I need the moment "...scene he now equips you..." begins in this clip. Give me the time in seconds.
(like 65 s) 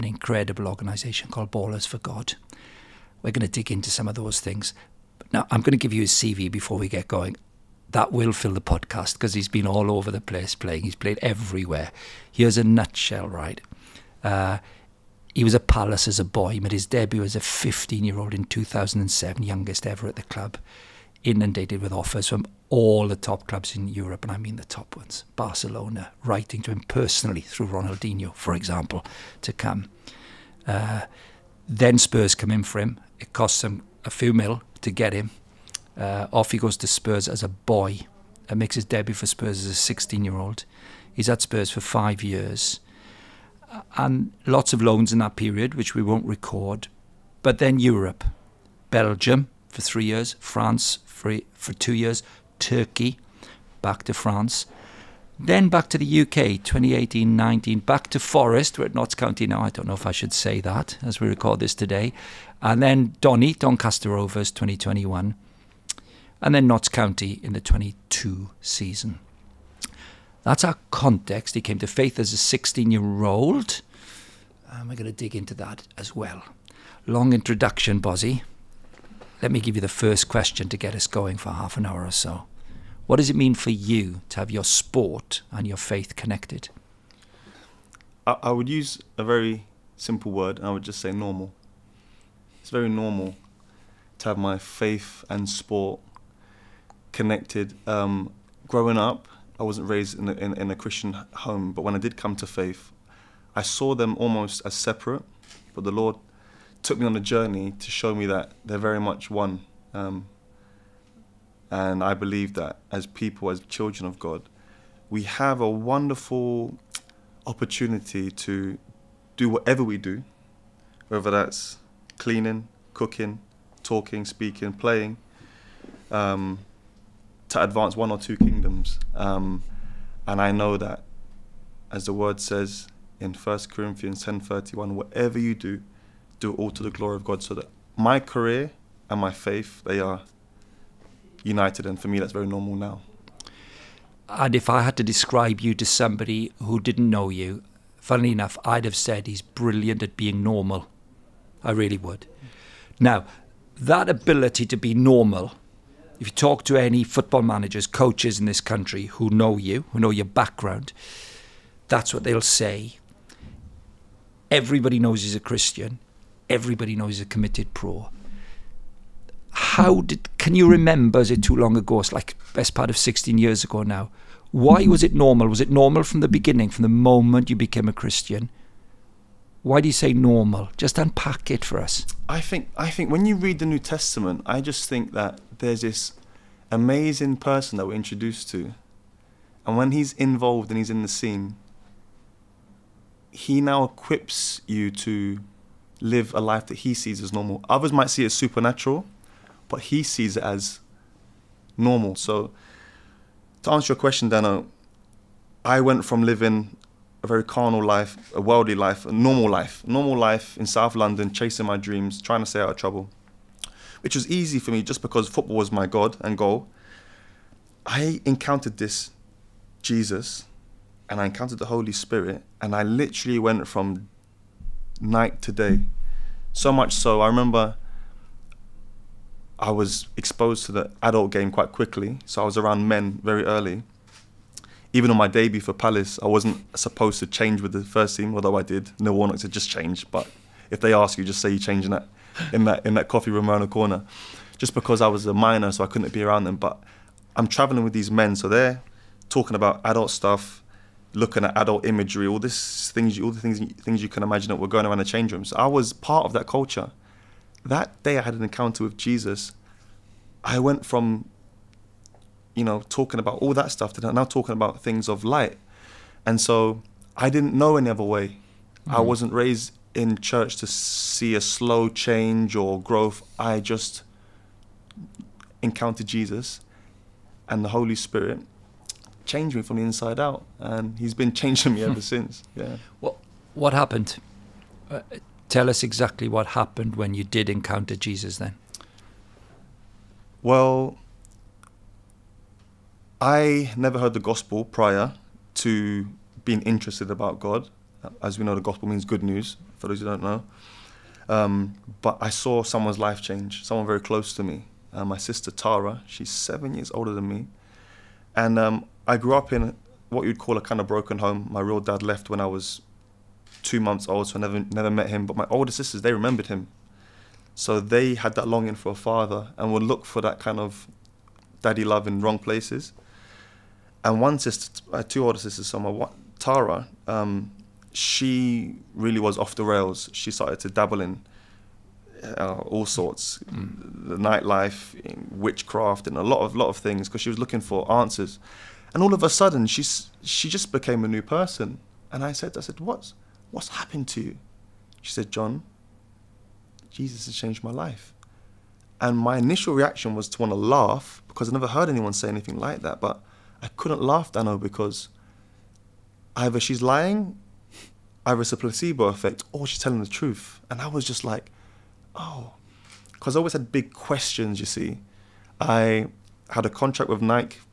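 191 s.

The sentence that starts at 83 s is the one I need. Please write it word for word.
What does it mean for you to have your sport and your faith connected?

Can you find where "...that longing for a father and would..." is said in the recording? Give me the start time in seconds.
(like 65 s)
318 s.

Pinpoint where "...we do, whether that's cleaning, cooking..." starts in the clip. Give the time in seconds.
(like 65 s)
119 s.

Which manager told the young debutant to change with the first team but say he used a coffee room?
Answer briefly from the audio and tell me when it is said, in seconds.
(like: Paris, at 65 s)
Neil Warnock, at 238 s.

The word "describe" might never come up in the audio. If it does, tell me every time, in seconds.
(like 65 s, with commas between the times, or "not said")
145 s.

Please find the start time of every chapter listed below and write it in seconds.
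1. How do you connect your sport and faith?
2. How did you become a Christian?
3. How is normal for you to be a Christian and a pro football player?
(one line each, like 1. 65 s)
1. 78 s
2. 282 s
3. 178 s.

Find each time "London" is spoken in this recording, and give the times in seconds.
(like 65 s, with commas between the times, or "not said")
210 s.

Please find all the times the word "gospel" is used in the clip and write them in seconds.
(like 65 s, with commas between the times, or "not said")
294 s, 298 s.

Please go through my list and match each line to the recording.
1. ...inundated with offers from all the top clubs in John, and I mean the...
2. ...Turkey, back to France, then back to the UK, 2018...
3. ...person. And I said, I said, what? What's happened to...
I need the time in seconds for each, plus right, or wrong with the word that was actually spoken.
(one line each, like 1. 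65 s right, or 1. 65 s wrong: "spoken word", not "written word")
1. 21 s wrong: "Europe", not "John"
2. 52 s right
3. 341 s right.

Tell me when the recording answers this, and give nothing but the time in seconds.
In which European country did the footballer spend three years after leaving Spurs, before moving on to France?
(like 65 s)
48 s.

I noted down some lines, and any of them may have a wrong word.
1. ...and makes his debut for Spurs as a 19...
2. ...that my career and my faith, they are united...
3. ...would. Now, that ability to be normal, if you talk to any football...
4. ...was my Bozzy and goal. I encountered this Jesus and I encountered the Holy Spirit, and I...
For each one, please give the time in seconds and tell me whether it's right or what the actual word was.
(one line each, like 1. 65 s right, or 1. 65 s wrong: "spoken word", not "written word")
1. 38 s wrong: "16", not "19"
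2. 137 s right
3. 151 s right
4. 215 s wrong: "God", not "Bozzy".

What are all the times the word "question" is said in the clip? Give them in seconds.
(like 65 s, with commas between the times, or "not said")
80 s, 203 s, 363 s.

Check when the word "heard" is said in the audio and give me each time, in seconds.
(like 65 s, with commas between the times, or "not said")
293 s, 351 s.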